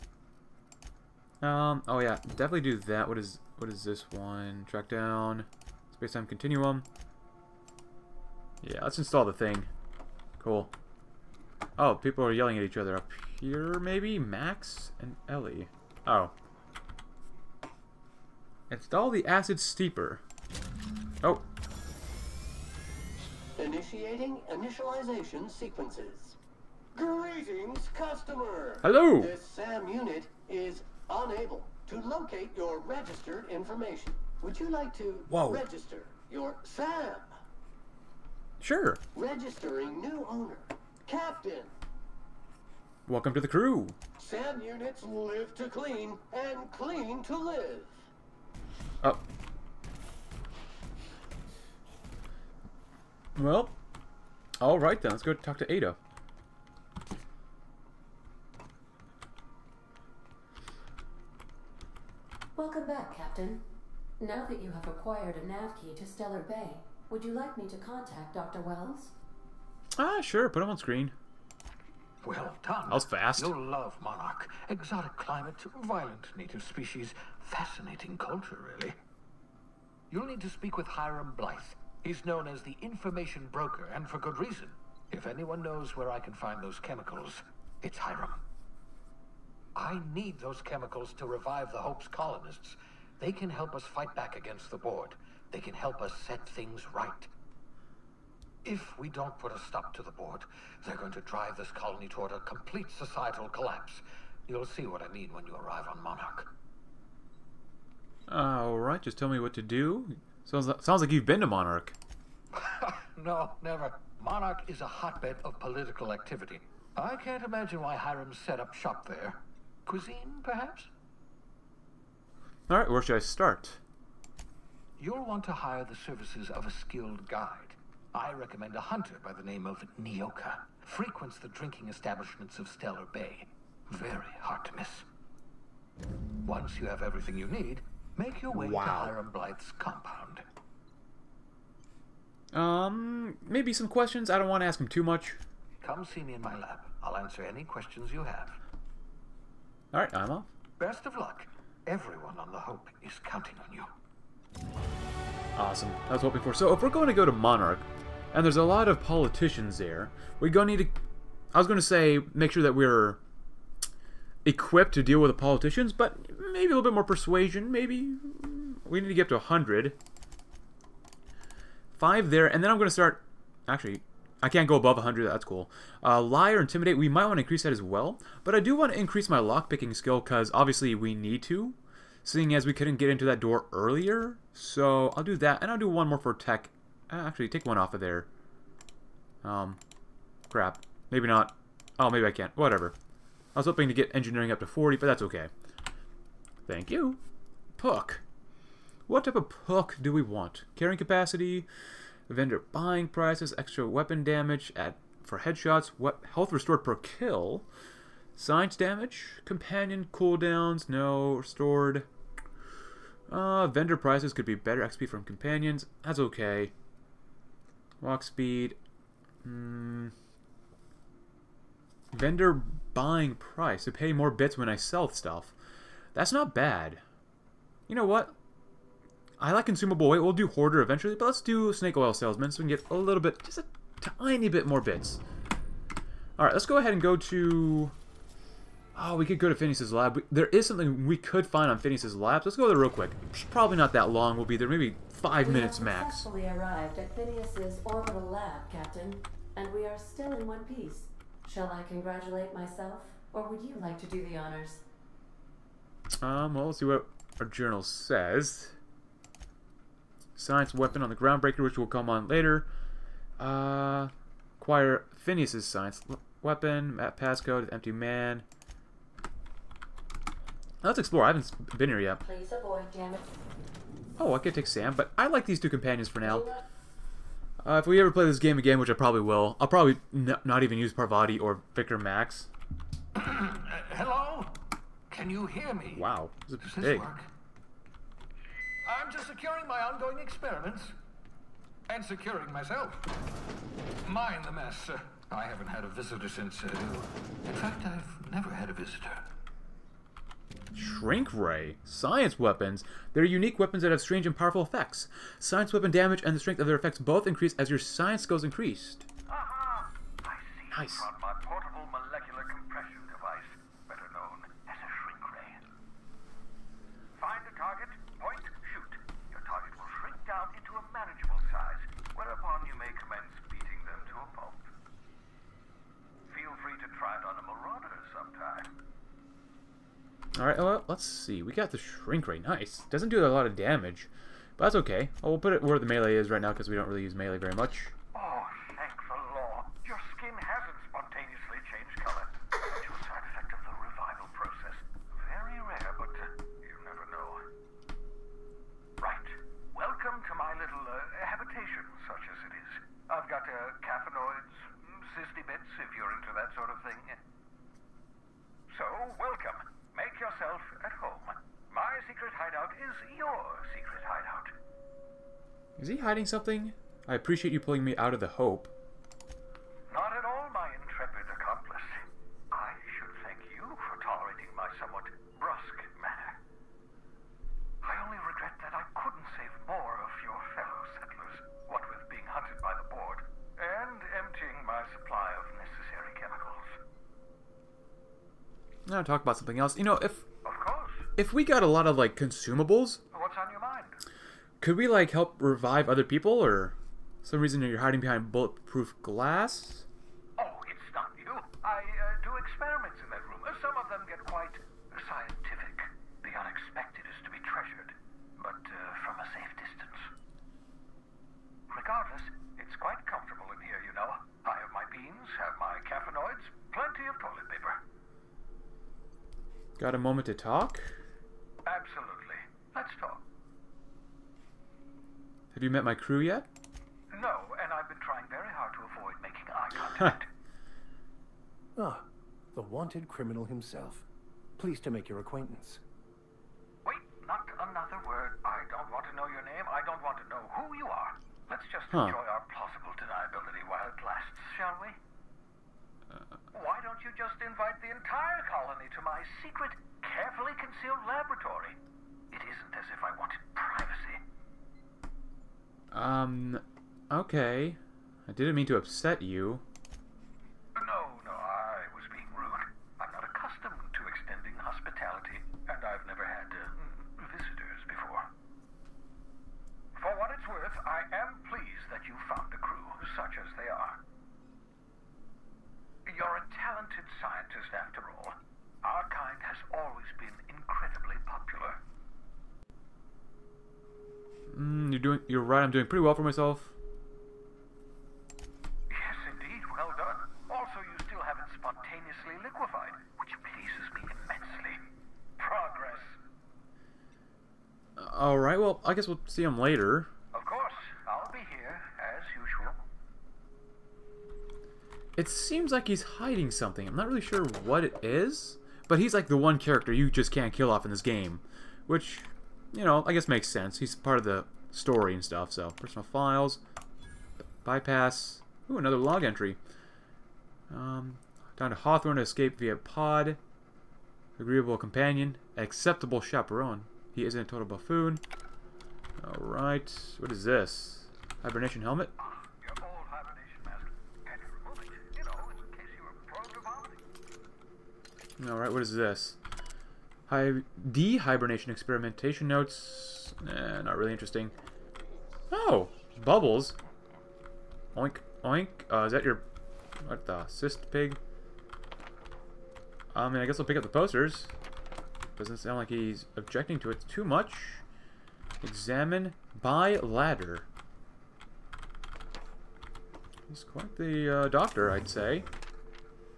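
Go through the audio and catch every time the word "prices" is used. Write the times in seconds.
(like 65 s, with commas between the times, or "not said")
203 s, 213 s, 223 s.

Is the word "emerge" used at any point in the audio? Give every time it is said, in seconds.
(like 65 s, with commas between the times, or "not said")
not said.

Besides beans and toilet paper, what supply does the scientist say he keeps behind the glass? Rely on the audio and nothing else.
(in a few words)
Caffeinoids.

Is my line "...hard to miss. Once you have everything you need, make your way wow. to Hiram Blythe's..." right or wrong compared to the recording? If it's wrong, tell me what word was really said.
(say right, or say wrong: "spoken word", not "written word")
right.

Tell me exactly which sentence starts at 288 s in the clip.
I'm just securing my ongoing experiments.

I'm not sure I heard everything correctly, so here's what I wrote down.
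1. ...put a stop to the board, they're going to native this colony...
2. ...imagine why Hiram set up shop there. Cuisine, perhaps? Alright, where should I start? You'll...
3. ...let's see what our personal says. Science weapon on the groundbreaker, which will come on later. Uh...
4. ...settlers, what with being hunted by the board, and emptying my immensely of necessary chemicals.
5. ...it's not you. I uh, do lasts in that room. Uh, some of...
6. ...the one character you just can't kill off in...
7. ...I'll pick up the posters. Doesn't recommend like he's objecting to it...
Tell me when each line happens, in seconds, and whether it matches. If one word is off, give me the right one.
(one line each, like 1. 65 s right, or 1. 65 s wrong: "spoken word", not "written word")
1. 99 s wrong: "drive", not "native"
2. 117 s right
3. 256 s wrong: "journal", not "personal"
4. 380 s wrong: "supply", not "immensely"
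5. 400 s wrong: "experiments", not "lasts"
6. 509 s right
7. 553 s wrong: "sound", not "recommend".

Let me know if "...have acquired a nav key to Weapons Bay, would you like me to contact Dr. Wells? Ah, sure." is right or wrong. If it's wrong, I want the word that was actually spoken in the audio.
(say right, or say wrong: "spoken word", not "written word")
wrong: "Stellar", not "Weapons".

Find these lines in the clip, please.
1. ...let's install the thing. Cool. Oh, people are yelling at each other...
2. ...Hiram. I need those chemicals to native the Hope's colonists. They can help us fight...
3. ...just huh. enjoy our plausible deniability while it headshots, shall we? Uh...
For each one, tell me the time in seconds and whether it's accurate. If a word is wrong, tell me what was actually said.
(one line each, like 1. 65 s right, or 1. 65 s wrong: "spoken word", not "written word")
1. 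8 s right
2. 87 s wrong: "revive", not "native"
3. 441 s wrong: "lasts", not "headshots".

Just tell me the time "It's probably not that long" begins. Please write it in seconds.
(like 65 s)
243 s.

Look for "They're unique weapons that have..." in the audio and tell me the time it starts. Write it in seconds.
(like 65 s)
303 s.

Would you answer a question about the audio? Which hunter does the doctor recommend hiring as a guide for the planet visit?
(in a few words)
Nioka.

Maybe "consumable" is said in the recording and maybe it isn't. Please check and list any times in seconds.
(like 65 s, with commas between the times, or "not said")
229 s, 392 s.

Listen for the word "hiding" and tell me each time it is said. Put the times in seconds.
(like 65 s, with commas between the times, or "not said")
365 s, 397 s, 506 s.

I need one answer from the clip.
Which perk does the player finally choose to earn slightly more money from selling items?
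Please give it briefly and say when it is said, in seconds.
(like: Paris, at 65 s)
Snake oil salesman, at 231 s.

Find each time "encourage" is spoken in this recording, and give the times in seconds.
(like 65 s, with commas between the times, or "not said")
not said.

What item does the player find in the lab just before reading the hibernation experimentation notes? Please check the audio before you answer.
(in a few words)
Hibernation helmet.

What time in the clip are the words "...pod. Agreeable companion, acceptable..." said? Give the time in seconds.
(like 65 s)
522 s.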